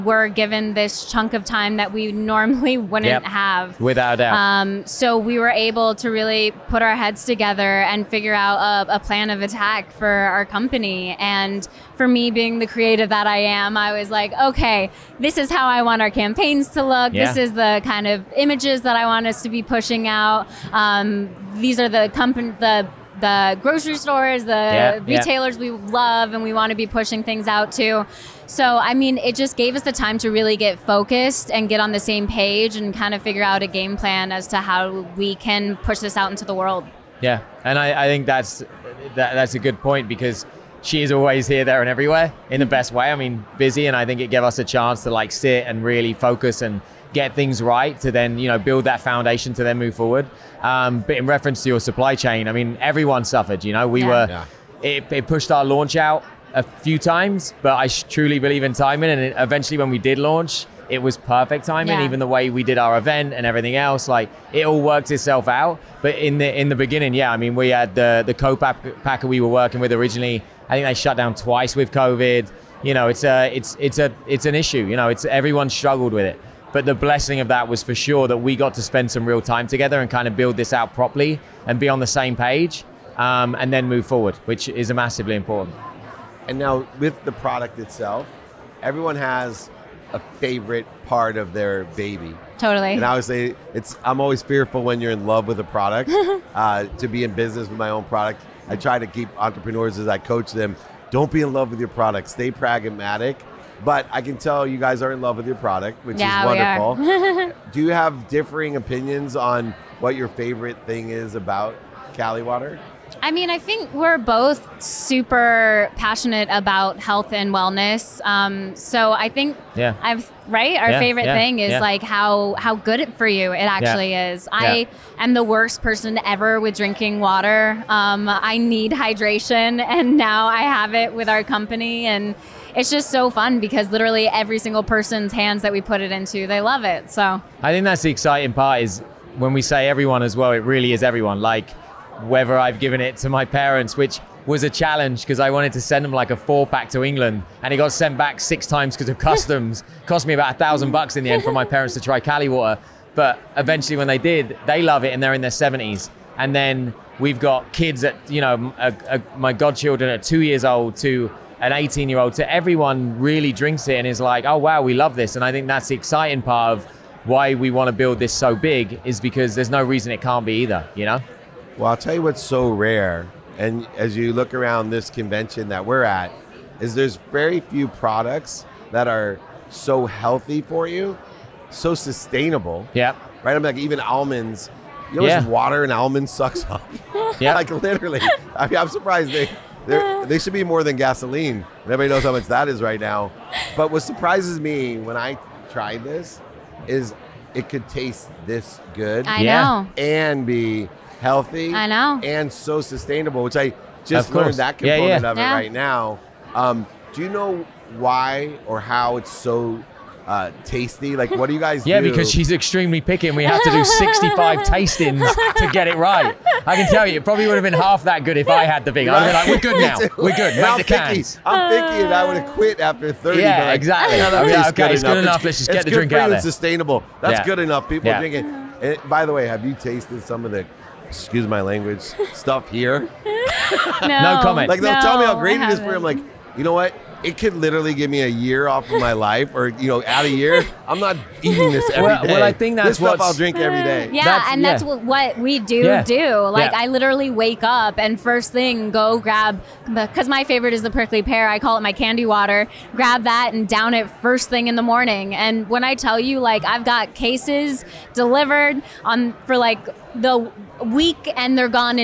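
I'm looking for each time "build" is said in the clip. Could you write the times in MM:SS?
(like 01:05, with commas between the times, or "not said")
00:48, 01:20, 02:47.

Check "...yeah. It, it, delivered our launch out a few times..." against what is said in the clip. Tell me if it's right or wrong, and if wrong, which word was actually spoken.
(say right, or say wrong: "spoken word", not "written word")
wrong: "pushed", not "delivered".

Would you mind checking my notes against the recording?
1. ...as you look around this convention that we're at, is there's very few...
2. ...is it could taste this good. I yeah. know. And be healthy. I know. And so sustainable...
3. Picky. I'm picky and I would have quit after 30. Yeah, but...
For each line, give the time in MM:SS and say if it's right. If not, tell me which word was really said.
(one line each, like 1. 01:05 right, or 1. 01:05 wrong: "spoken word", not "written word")
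1. 02:53 right
2. 03:16 right
3. 03:41 right.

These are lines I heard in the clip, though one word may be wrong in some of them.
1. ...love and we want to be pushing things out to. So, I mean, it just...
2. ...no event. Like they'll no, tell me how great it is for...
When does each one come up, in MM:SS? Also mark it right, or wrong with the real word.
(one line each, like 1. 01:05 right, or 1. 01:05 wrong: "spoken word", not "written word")
1. 00:25 right
2. 03:54 wrong: "comment", not "event".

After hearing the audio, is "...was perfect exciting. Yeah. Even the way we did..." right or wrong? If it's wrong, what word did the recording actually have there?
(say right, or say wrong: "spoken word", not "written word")
wrong: "timing", not "exciting".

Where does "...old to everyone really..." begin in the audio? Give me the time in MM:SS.
02:42.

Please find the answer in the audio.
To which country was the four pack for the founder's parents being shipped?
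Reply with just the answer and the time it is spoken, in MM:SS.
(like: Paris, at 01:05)
England, at 02:27.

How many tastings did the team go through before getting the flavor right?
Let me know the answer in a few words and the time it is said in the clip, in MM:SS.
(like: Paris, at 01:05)
65, at 03:33.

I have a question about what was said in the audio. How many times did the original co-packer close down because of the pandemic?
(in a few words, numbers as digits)
2.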